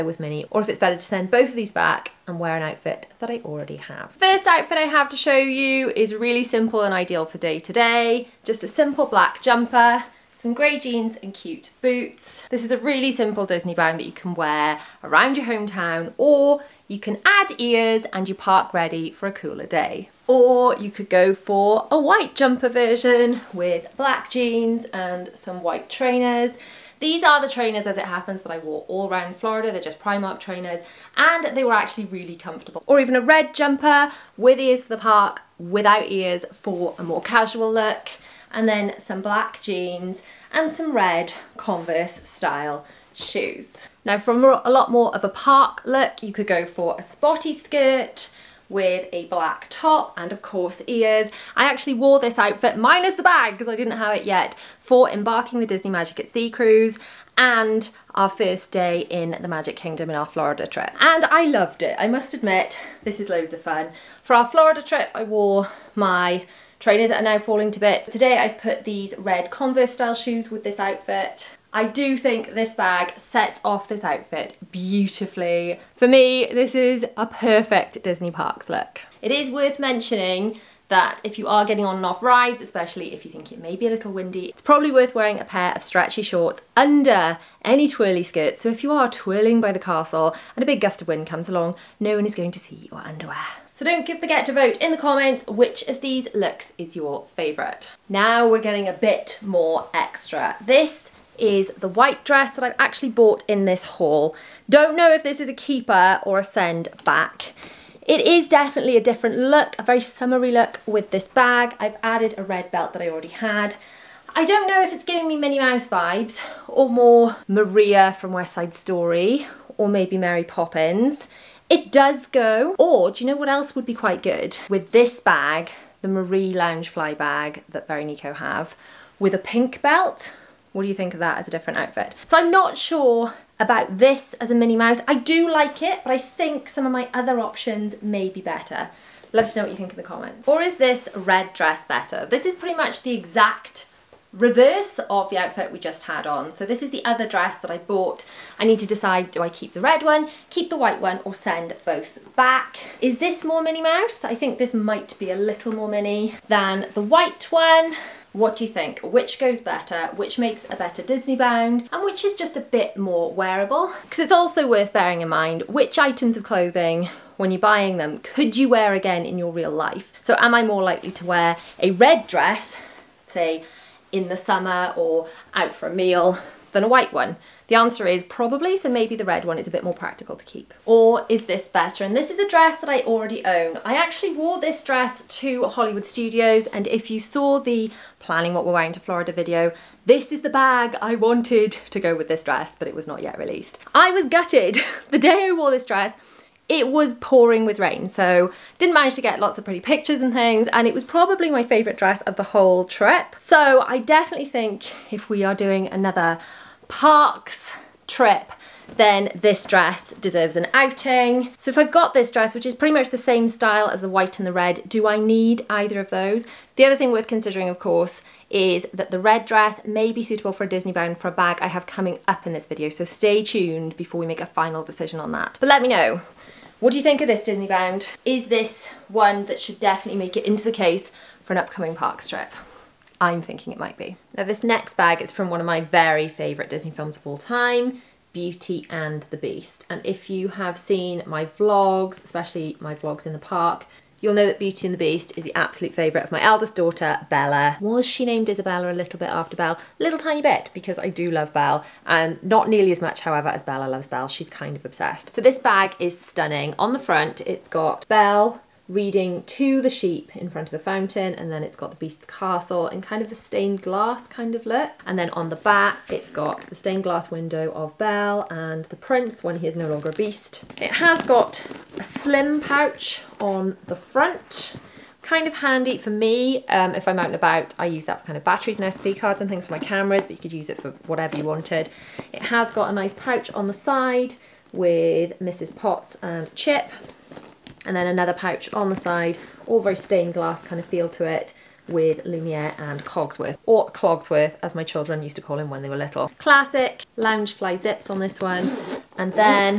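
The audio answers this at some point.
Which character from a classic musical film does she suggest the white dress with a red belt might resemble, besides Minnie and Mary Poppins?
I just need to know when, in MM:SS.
01:57.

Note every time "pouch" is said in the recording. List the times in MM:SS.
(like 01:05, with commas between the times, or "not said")
04:32, 04:43, 04:48.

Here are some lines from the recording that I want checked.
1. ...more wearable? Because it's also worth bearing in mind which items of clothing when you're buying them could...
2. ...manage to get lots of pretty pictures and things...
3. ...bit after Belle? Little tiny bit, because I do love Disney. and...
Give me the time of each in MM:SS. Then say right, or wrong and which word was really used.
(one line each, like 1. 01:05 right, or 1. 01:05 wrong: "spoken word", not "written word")
1. 02:42 right
2. 03:18 right
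3. 04:09 wrong: "Belle", not "Disney".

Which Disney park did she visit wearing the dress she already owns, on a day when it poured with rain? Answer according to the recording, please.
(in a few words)
Hollywood Studios.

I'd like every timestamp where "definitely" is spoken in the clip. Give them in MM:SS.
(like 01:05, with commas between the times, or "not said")
01:48, 03:23, 03:49.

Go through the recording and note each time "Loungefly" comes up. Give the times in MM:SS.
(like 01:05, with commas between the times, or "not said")
02:06, 04:57.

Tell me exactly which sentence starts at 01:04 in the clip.
For our Florida trip, I wore my trainers are now falling to bits.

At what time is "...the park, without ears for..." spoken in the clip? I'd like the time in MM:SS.
00:34.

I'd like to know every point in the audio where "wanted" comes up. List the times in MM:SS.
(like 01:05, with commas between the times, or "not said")
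03:11, 04:41.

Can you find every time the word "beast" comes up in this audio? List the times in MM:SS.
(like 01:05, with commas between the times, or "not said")
03:59, 04:04, 04:21, 04:30.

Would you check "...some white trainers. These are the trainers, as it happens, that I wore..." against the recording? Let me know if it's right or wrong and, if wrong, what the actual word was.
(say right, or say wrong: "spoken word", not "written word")
right.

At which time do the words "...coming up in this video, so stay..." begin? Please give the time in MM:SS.
03:41.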